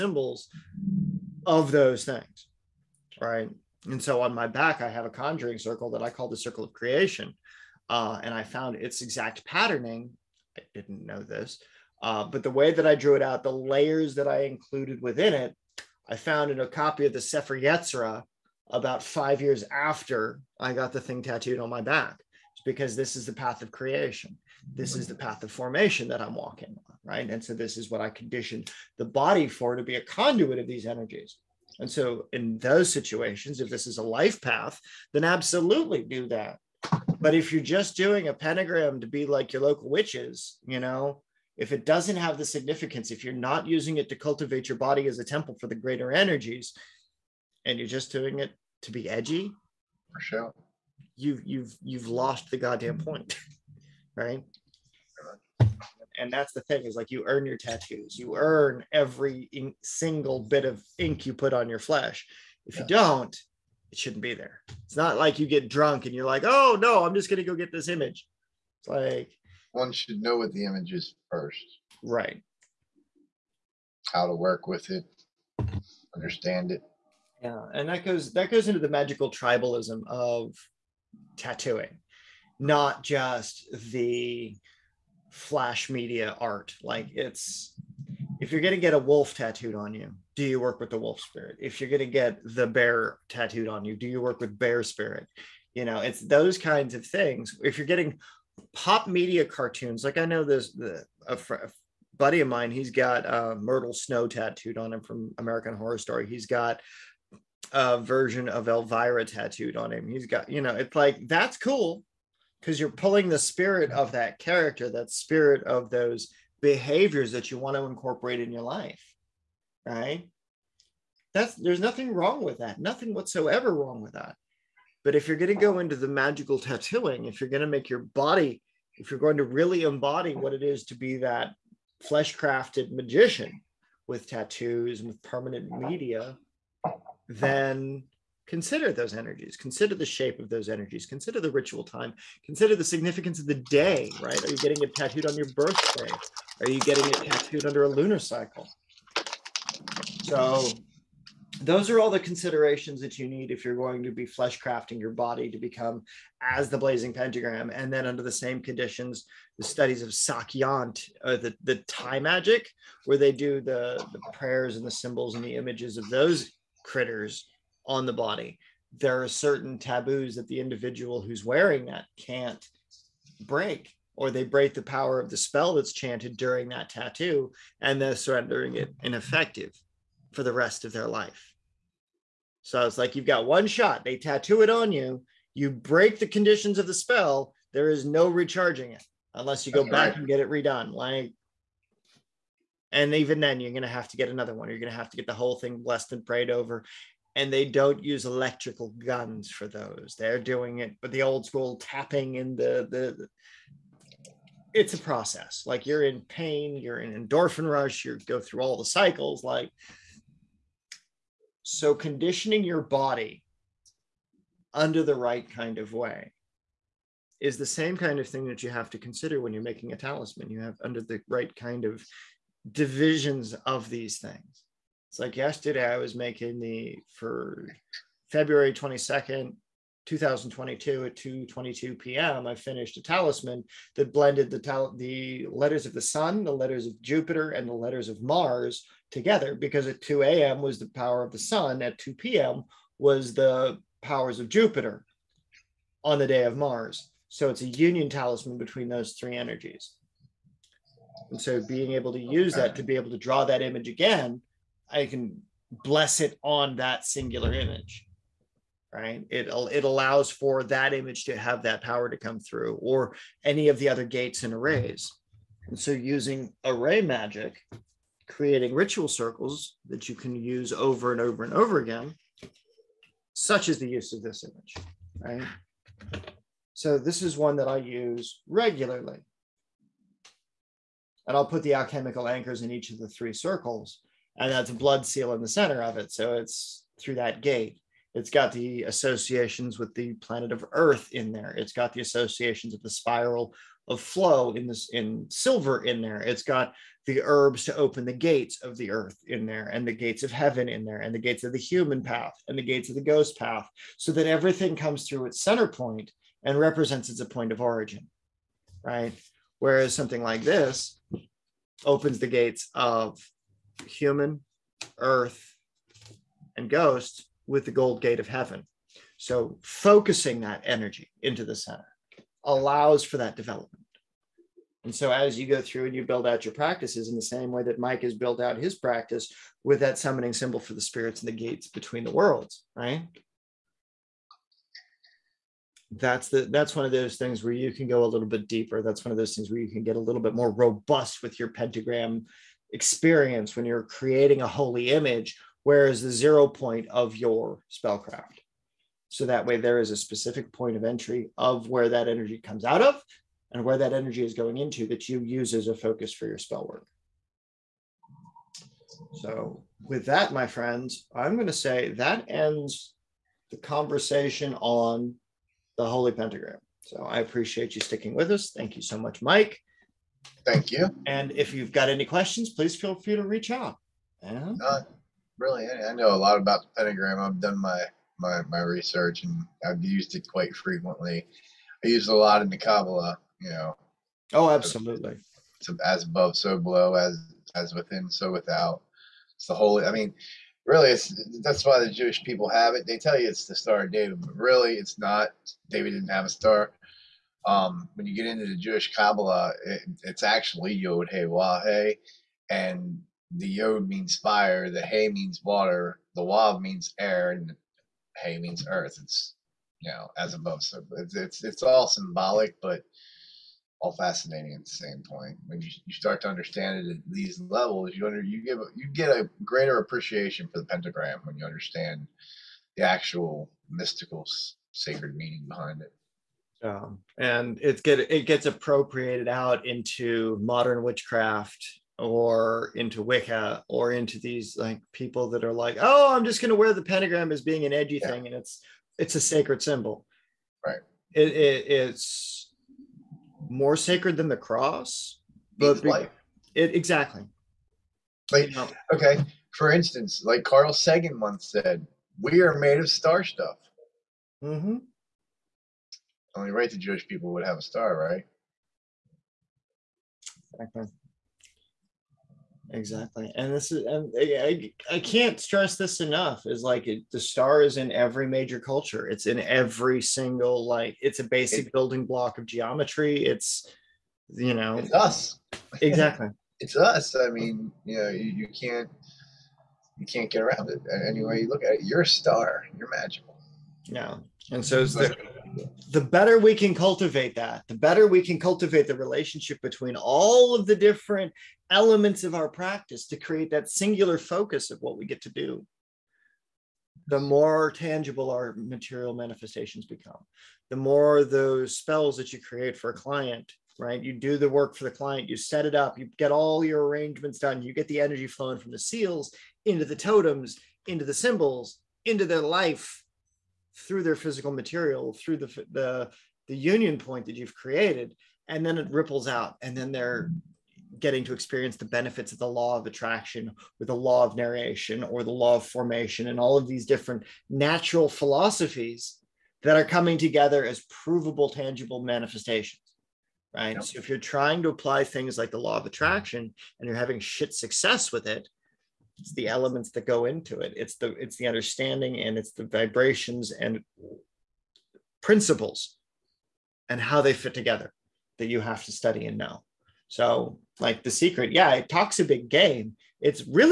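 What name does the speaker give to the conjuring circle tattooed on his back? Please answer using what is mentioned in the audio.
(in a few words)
circle of creation.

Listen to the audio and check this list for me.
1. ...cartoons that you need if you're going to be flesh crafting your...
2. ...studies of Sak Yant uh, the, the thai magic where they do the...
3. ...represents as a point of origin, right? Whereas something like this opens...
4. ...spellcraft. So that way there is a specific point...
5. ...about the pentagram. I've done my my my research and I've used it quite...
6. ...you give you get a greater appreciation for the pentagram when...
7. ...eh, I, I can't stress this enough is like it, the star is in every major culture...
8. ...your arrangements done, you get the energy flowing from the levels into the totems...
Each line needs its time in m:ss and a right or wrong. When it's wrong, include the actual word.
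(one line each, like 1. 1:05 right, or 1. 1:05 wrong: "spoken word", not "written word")
1. 2:32 wrong: "considerations", not "cartoons"
2. 2:39 right
3. 5:06 right
4. 5:47 right
5. 6:16 right
6. 6:58 right
7. 7:44 right
8. 8:26 wrong: "seals", not "levels".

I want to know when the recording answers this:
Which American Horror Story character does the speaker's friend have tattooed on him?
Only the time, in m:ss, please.
1:43.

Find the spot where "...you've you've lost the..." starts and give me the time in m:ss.
0:51.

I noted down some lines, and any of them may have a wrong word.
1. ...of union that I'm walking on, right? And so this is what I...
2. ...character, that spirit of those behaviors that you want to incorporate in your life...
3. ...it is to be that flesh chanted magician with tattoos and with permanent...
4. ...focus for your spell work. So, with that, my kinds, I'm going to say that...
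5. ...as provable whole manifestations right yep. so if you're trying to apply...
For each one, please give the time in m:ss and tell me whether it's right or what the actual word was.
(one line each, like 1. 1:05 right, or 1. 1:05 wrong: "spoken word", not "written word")
1. 0:25 wrong: "formation", not "union"
2. 1:54 right
3. 2:10 wrong: "crafted", not "chanted"
4. 5:55 wrong: "friends", not "kinds"
5. 8:50 wrong: "tangible", not "whole".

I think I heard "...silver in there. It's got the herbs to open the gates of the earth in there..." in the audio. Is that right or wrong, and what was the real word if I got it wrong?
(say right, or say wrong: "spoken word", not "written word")
right.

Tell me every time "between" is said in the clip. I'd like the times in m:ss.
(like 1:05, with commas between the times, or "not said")
4:08, 5:31, 8:09.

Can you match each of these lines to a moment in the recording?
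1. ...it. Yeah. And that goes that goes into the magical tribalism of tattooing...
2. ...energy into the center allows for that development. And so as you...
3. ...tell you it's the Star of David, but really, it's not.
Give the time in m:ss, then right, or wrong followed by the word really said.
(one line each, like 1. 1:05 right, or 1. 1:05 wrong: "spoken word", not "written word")
1. 1:16 right
2. 5:20 right
3. 6:32 right.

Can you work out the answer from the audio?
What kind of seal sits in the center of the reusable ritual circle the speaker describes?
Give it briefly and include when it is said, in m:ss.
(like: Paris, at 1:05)
blood seal, at 4:44.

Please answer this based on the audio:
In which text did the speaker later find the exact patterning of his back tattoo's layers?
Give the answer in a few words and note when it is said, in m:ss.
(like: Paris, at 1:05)
Sefer Yetzirah, at 0:17.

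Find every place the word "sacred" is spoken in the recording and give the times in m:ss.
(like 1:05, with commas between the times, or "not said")
7:04, 7:19, 7:23.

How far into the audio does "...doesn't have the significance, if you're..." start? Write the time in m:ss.
0:41.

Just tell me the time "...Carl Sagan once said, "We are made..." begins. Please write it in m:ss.
7:30.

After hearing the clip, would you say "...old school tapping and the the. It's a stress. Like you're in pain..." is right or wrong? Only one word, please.
wrong.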